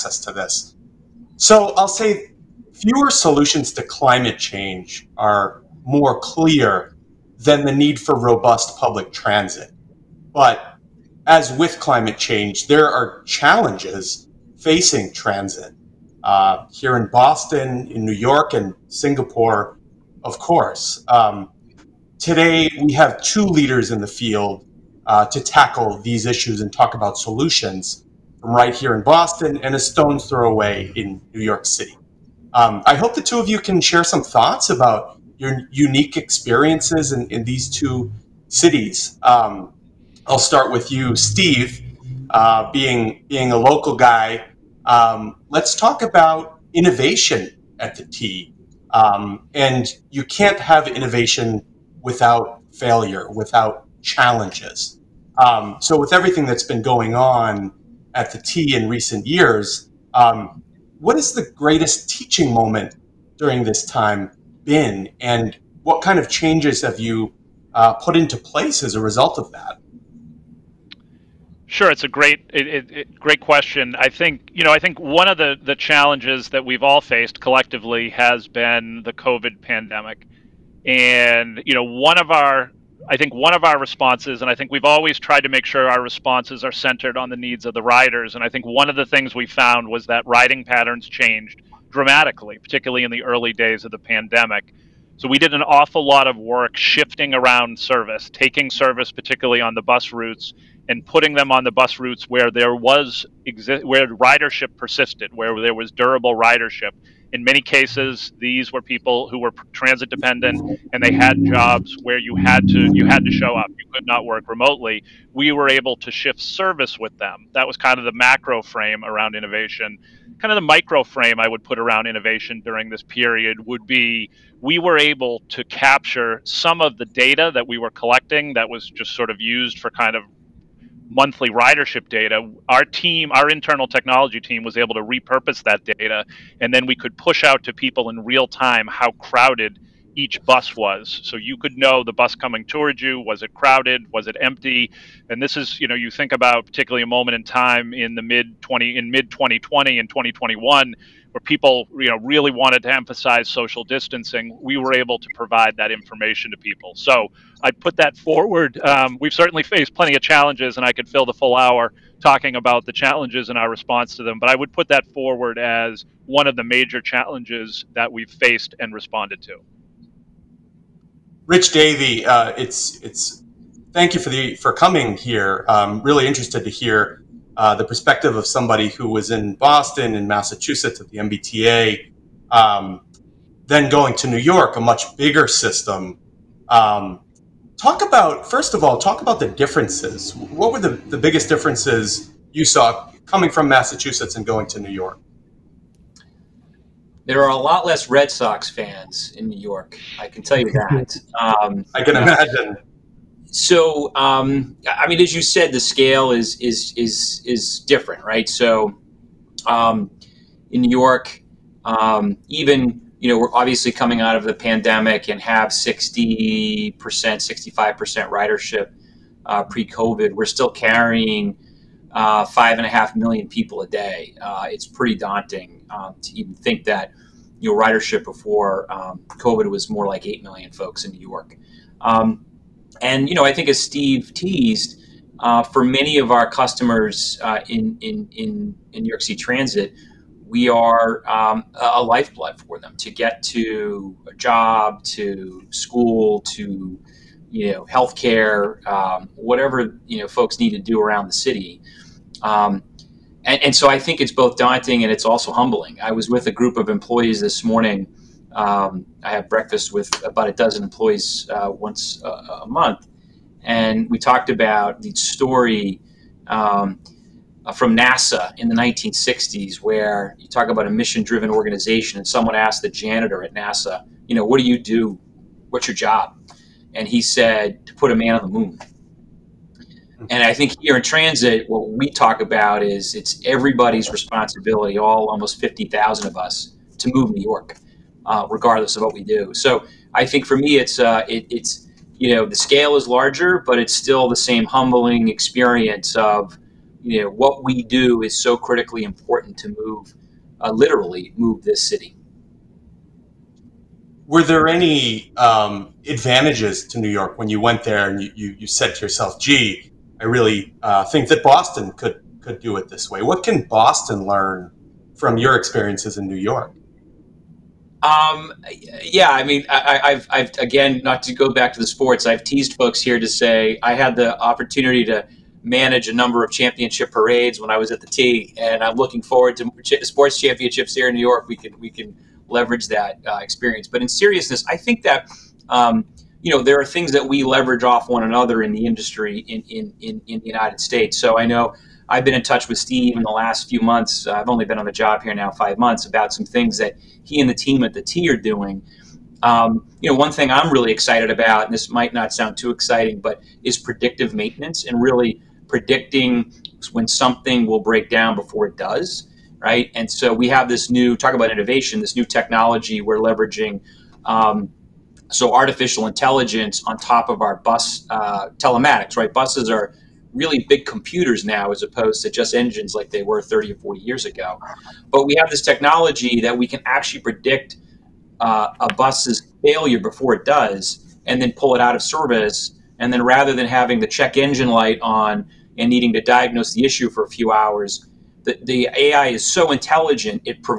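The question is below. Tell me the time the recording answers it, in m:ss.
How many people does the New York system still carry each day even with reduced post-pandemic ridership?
3:42.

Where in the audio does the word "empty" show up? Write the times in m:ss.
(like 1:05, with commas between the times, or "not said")
2:24.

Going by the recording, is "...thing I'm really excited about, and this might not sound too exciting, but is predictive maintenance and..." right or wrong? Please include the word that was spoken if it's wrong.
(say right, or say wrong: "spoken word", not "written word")
right.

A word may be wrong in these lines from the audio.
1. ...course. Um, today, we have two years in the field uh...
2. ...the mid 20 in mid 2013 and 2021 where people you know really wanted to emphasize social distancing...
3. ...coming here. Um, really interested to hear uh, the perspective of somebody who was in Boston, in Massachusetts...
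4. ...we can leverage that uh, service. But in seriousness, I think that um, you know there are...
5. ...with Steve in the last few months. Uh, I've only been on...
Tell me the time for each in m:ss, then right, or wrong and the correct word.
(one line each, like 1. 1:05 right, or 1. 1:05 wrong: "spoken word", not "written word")
1. 0:20 wrong: "leaders", not "years"
2. 2:28 wrong: "2020", not "2013"
3. 2:54 right
4. 5:31 wrong: "experience", not "service"
5. 5:42 right.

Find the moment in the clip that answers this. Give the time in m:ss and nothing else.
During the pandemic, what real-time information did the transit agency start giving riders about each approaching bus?
2:18.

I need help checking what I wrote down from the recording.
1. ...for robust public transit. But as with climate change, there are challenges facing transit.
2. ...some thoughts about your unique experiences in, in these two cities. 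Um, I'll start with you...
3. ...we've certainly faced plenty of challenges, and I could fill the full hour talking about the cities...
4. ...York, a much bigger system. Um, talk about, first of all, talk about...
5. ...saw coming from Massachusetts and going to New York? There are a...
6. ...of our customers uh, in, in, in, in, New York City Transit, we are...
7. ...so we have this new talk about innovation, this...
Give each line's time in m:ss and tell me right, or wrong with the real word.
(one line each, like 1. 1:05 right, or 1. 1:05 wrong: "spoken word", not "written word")
1. 0:07 right
2. 0:34 right
3. 2:39 wrong: "challenges", not "cities"
4. 3:04 right
5. 3:12 right
6. 3:56 right
7. 6:00 right.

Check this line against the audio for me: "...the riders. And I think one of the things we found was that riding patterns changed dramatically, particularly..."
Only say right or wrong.
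right.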